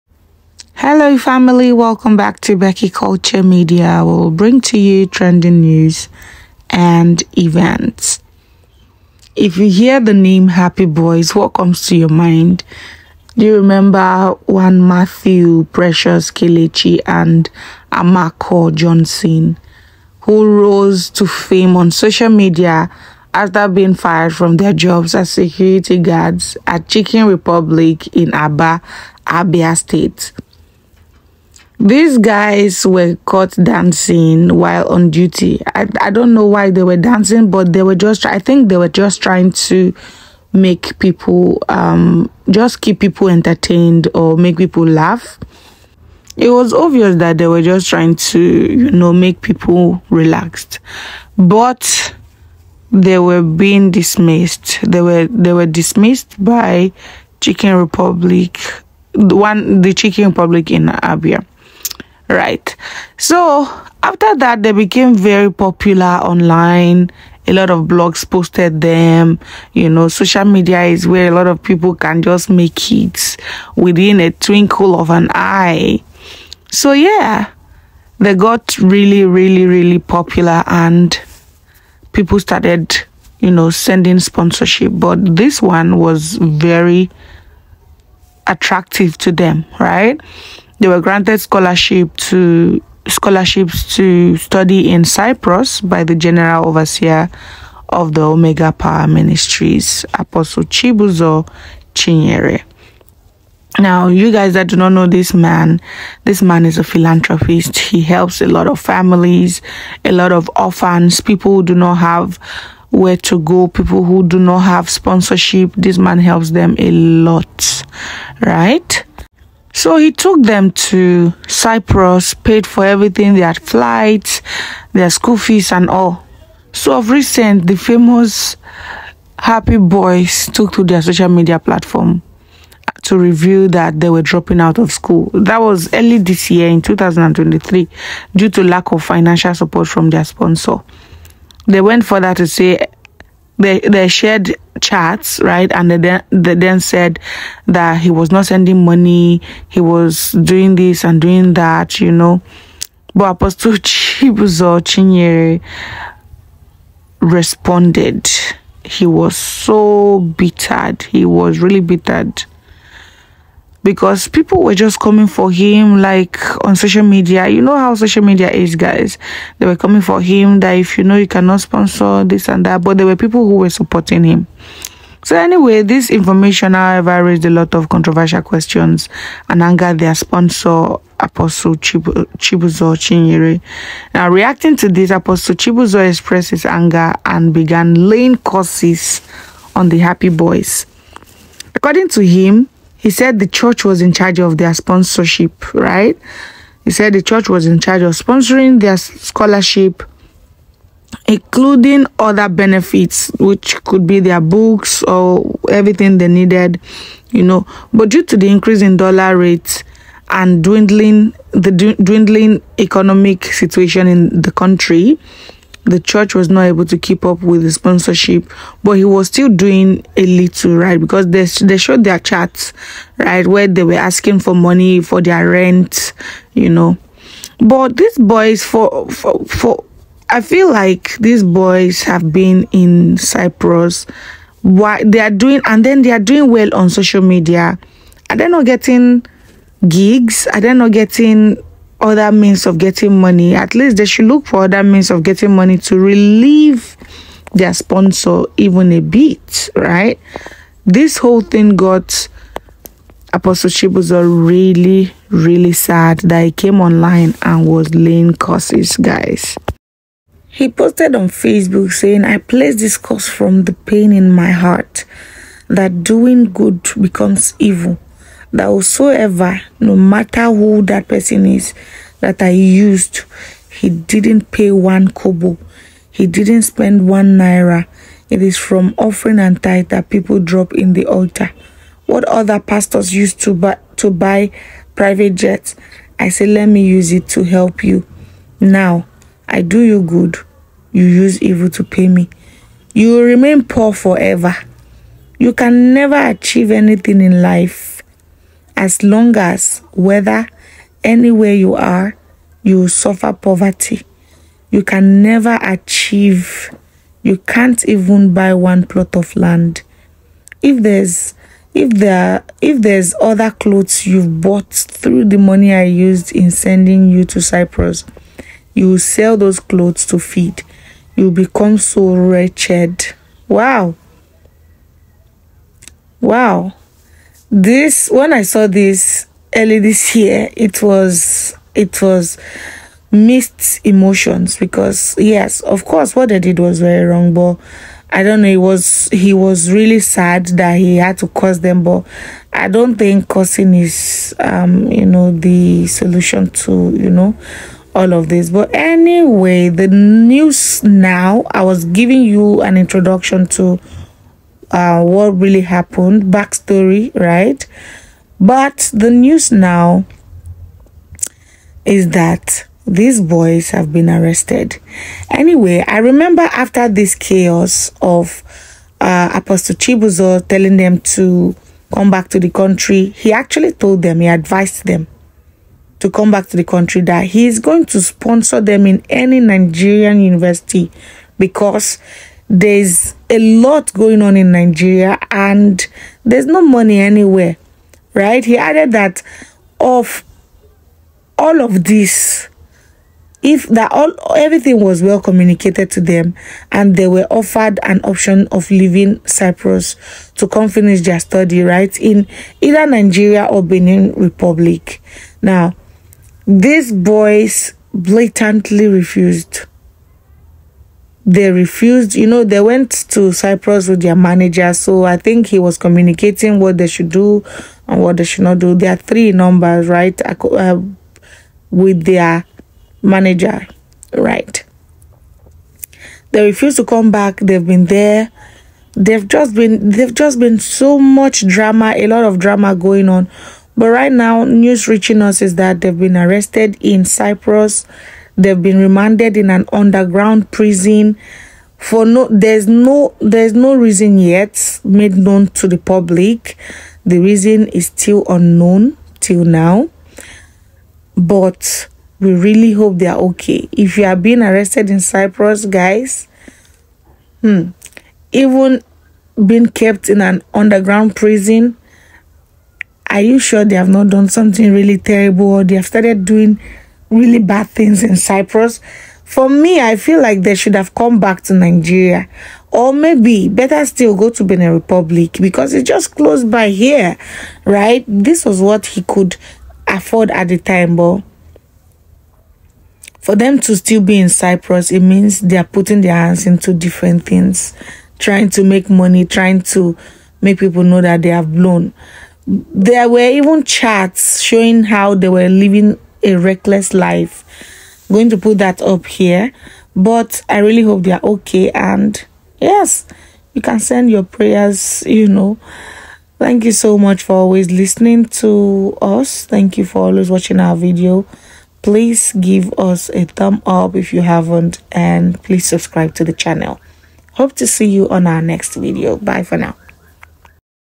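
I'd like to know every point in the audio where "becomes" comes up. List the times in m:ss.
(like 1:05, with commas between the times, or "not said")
4:26, 5:21.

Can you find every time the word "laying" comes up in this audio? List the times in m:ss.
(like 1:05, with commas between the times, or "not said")
3:08, 4:17.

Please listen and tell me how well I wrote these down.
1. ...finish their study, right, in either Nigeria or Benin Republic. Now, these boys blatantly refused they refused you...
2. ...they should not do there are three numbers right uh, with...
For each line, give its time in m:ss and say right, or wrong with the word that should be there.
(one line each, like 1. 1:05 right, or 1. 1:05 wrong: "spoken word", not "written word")
1. 6:40 right
2. 6:58 right.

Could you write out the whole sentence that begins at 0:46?
It was obvious that they were just trying to, you know, make people relaxed.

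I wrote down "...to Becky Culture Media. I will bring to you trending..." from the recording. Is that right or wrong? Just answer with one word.
right.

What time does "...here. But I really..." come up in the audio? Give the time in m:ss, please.
8:19.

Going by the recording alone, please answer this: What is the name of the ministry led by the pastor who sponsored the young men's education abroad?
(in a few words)
Omega Power Ministries.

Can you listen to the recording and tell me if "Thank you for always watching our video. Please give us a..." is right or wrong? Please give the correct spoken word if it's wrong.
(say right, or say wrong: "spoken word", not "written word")
right.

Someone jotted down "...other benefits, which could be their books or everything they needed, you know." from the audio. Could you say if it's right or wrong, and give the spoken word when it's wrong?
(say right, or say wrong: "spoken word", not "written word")
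right.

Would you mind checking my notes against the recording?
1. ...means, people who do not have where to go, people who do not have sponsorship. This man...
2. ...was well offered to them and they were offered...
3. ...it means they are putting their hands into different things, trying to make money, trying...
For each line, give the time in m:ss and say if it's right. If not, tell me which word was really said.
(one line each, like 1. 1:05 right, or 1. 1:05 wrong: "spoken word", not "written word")
1. 1:50 wrong: "orphans", not "means"
2. 6:34 wrong: "communicated", not "offered"
3. 8:04 right.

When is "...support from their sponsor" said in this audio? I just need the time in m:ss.
2:19.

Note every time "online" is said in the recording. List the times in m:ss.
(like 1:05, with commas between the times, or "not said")
1:06, 4:16.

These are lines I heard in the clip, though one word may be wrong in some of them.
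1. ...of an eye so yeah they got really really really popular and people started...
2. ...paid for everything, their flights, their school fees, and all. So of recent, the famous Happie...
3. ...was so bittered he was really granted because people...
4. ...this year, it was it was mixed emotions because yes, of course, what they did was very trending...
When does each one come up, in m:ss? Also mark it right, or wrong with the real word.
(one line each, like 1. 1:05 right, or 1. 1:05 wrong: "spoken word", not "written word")
1. 1:14 right
2. 2:02 right
3. 2:39 wrong: "bittered", not "granted"
4. 5:29 wrong: "wrong", not "trending".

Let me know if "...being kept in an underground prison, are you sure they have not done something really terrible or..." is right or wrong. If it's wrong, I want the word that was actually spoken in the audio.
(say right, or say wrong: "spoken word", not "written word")
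right.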